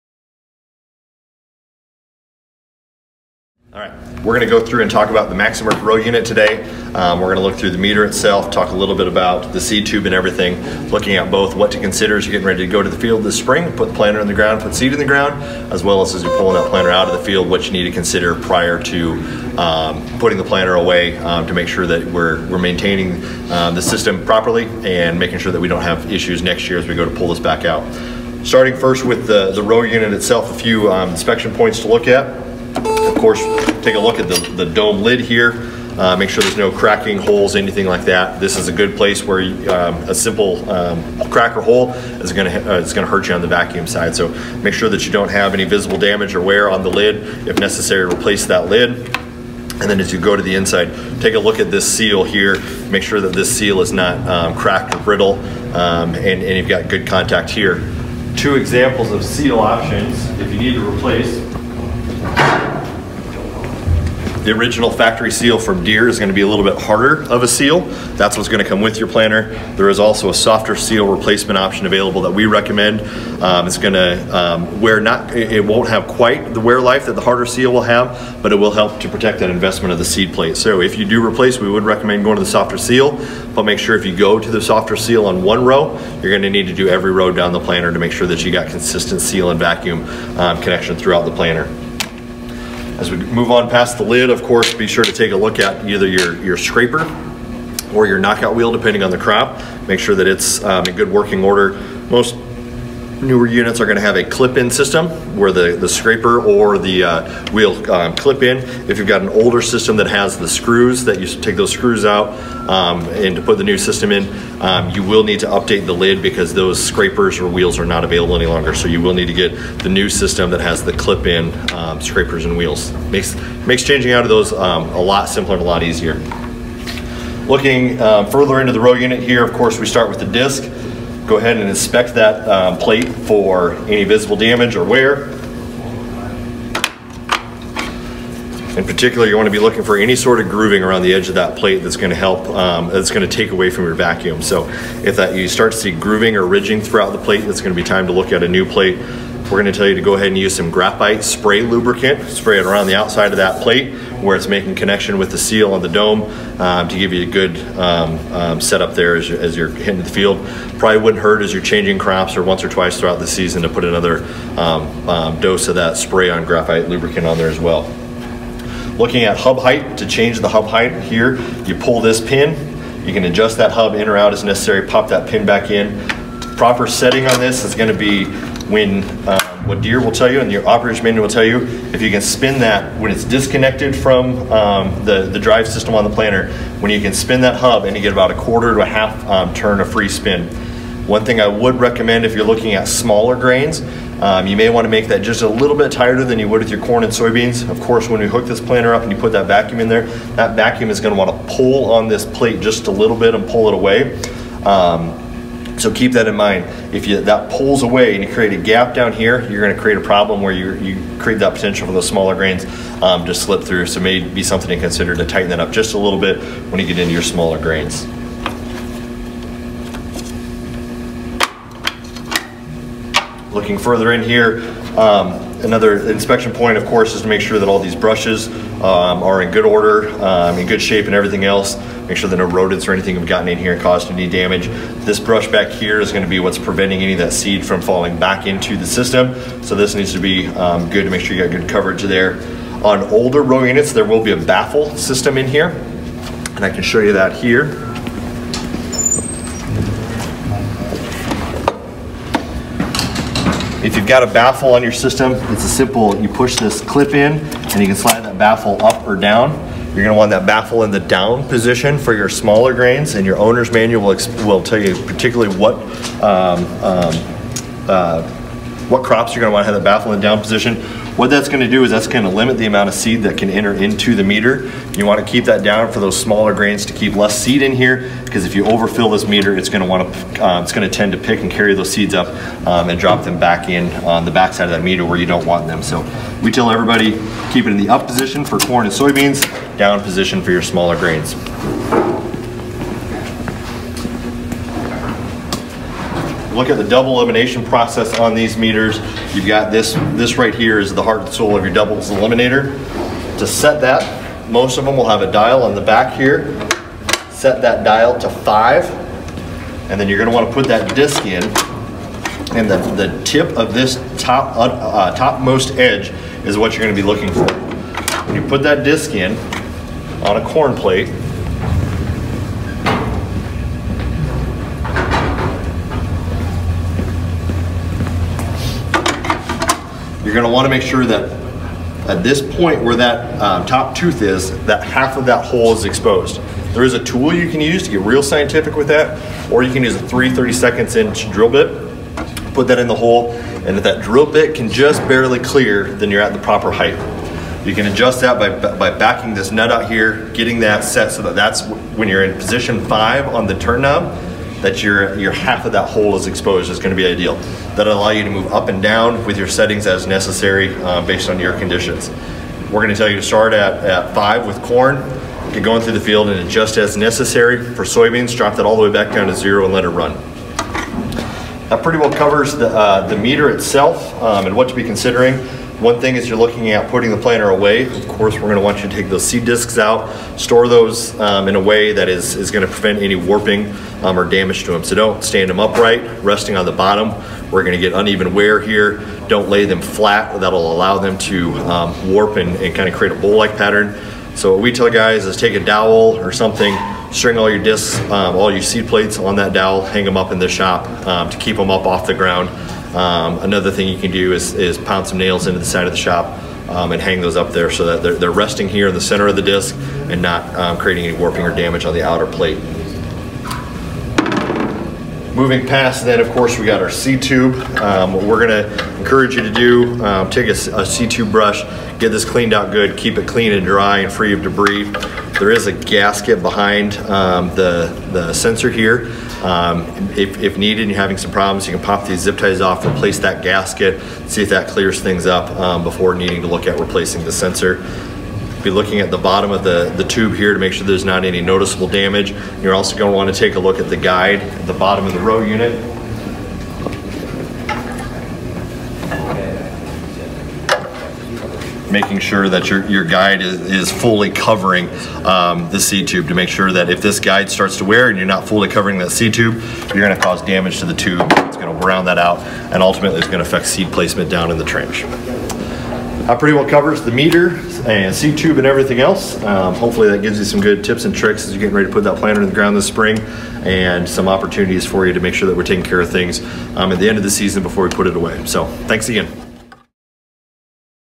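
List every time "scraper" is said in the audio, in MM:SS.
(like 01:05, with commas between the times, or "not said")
01:36, 01:45, 01:56, 02:02.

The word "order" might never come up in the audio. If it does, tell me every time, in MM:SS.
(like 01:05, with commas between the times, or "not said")
01:41, 03:49.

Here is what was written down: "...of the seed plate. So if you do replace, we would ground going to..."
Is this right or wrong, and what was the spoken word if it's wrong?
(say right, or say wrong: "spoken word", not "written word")
wrong: "recommend", not "ground".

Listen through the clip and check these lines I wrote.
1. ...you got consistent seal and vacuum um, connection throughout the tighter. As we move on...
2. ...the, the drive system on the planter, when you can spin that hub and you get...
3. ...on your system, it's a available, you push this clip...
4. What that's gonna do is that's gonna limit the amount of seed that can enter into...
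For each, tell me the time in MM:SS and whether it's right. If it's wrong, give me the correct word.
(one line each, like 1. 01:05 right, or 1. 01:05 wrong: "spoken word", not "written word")
1. 01:28 wrong: "planter", not "tighter"
2. 03:05 right
3. 04:14 wrong: "simple", not "available"
4. 04:31 right.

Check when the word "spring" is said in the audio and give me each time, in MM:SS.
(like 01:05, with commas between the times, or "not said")
00:13, 07:52.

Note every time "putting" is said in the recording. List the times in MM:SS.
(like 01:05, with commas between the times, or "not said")
00:20, 06:16.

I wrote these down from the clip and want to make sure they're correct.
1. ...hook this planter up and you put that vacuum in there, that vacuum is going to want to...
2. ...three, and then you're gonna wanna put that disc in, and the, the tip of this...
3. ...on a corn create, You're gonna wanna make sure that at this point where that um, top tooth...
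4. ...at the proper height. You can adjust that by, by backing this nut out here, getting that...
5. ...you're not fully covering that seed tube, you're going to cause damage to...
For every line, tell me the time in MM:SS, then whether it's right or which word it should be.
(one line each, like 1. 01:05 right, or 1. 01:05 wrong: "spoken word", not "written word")
1. 03:18 right
2. 05:08 wrong: "five", not "three"
3. 05:20 wrong: "plate", not "create"
4. 05:46 right
5. 07:38 right.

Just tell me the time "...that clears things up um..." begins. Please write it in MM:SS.
07:14.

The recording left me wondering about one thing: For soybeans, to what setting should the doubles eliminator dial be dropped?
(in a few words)
0.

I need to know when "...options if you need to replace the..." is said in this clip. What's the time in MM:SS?
00:59.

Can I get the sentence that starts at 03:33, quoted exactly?
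So may be something to consider to tighten that up just a little bit when you get into your smaller grains.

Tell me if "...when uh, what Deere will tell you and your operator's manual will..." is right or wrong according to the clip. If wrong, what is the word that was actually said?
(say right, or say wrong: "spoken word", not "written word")
right.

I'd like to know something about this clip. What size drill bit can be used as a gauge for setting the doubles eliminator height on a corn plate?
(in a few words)
3/32 inch.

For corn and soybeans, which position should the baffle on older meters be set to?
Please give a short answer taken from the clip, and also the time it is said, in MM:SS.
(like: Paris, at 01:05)
up position, at 04:47.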